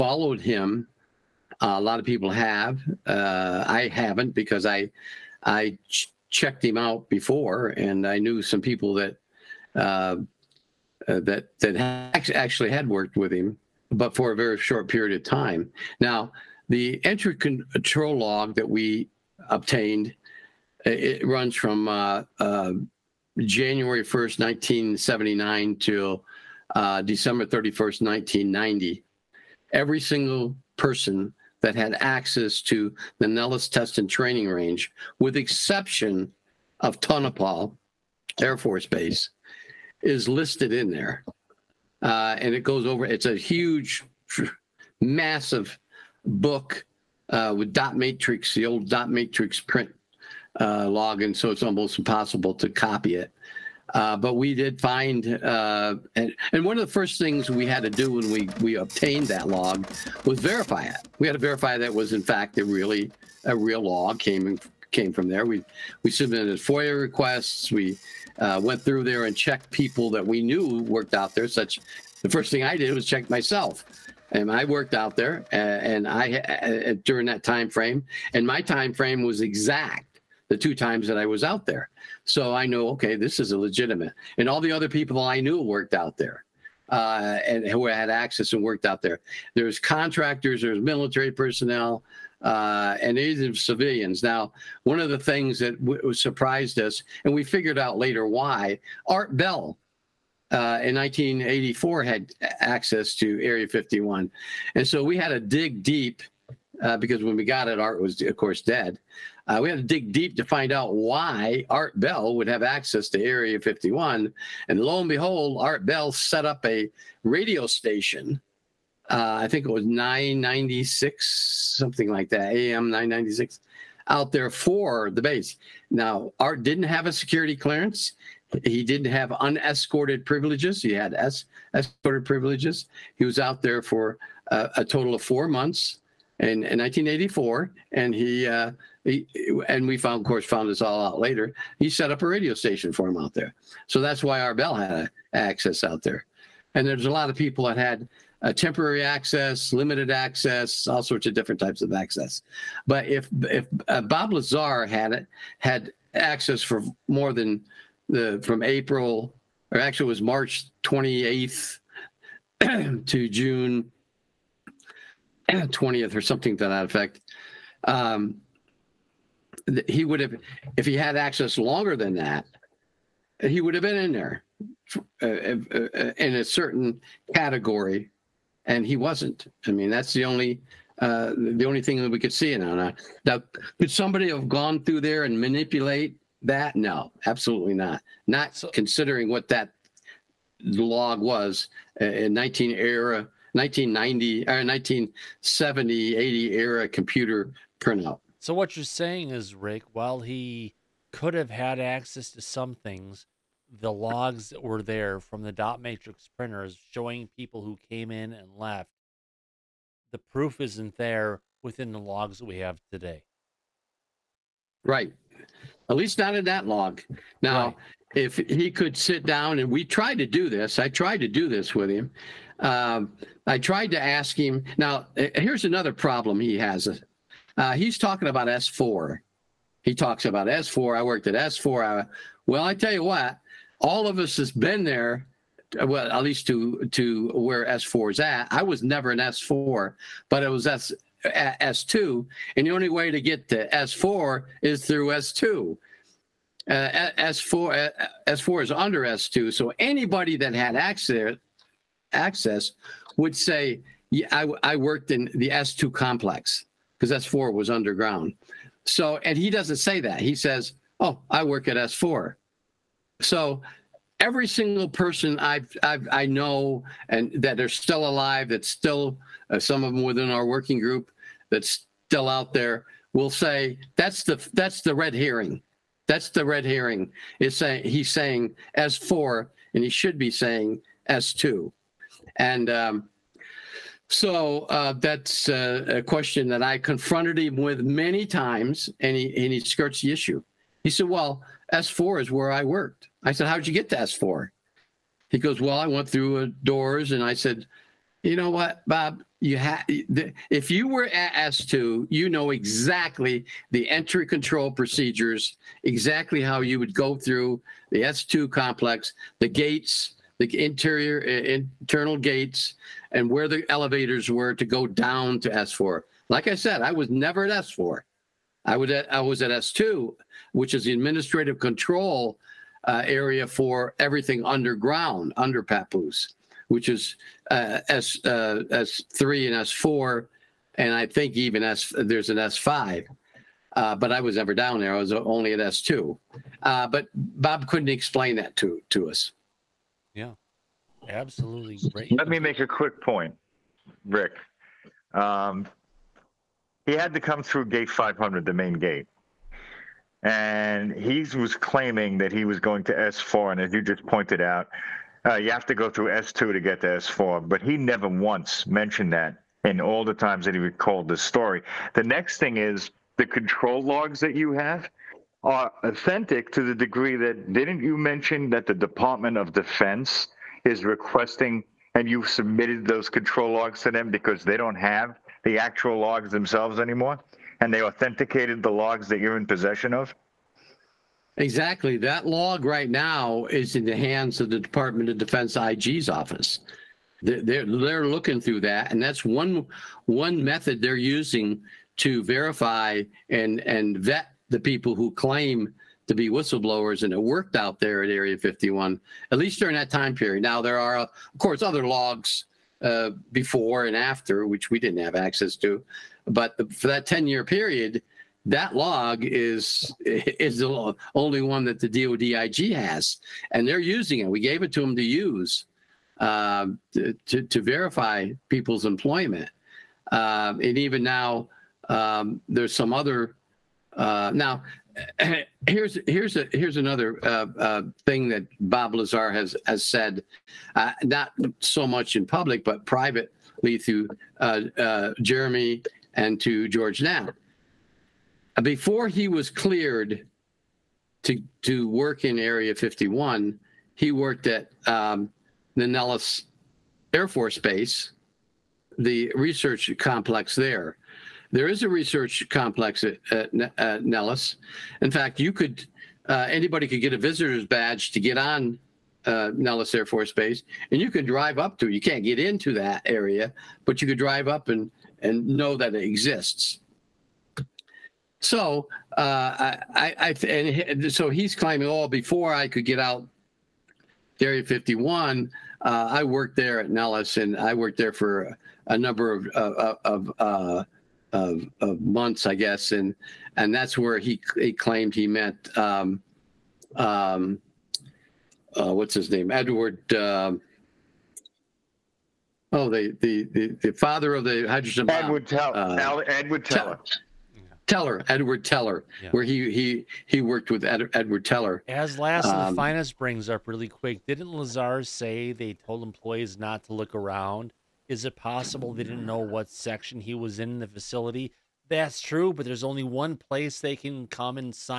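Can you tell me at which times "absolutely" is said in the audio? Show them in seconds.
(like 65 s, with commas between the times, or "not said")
187 s, 341 s.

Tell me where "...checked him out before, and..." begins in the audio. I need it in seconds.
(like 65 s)
6 s.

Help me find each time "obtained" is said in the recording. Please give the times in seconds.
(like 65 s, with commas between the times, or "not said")
19 s, 58 s.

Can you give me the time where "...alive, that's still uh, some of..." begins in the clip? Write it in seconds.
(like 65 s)
268 s.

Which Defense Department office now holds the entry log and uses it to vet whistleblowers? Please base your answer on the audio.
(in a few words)
IG's office.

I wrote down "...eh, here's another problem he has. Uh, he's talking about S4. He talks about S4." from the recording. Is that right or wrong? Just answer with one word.
right.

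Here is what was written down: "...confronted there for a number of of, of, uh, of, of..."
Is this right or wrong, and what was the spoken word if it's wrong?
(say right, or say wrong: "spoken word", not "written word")
wrong: "worked", not "confronted".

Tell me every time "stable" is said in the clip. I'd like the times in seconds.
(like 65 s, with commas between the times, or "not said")
not said.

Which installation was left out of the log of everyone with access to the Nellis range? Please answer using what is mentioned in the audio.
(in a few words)
Tonopah Air Force Base.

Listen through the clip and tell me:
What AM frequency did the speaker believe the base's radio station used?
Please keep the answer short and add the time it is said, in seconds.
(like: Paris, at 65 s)
996, at 122 s.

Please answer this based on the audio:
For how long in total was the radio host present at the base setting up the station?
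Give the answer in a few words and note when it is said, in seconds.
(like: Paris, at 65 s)
four months, at 135 s.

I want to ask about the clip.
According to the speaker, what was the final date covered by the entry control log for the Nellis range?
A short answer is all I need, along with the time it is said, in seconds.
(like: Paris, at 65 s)
December 31st, 1990, at 27 s.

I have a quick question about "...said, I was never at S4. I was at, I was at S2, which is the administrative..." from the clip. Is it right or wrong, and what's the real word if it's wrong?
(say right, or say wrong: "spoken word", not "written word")
right.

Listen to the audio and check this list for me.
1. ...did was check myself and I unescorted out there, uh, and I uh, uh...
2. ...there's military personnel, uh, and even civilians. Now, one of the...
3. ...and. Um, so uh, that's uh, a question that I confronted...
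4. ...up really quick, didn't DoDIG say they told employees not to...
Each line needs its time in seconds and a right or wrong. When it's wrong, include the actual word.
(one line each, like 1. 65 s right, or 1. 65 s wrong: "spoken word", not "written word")
1. 72 s wrong: "worked", not "unescorted"
2. 90 s right
3. 282 s right
4. 503 s wrong: "Lazar", not "DoDIG".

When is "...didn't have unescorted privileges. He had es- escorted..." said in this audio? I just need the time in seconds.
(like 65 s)
128 s.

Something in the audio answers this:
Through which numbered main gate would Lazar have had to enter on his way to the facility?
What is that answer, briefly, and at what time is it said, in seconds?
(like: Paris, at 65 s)
gate 500, at 347 s.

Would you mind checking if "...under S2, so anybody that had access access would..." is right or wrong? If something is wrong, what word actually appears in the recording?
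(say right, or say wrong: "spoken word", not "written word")
right.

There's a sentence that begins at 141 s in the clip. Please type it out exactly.
He set up a radio station for him out there.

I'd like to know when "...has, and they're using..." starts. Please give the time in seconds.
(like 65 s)
412 s.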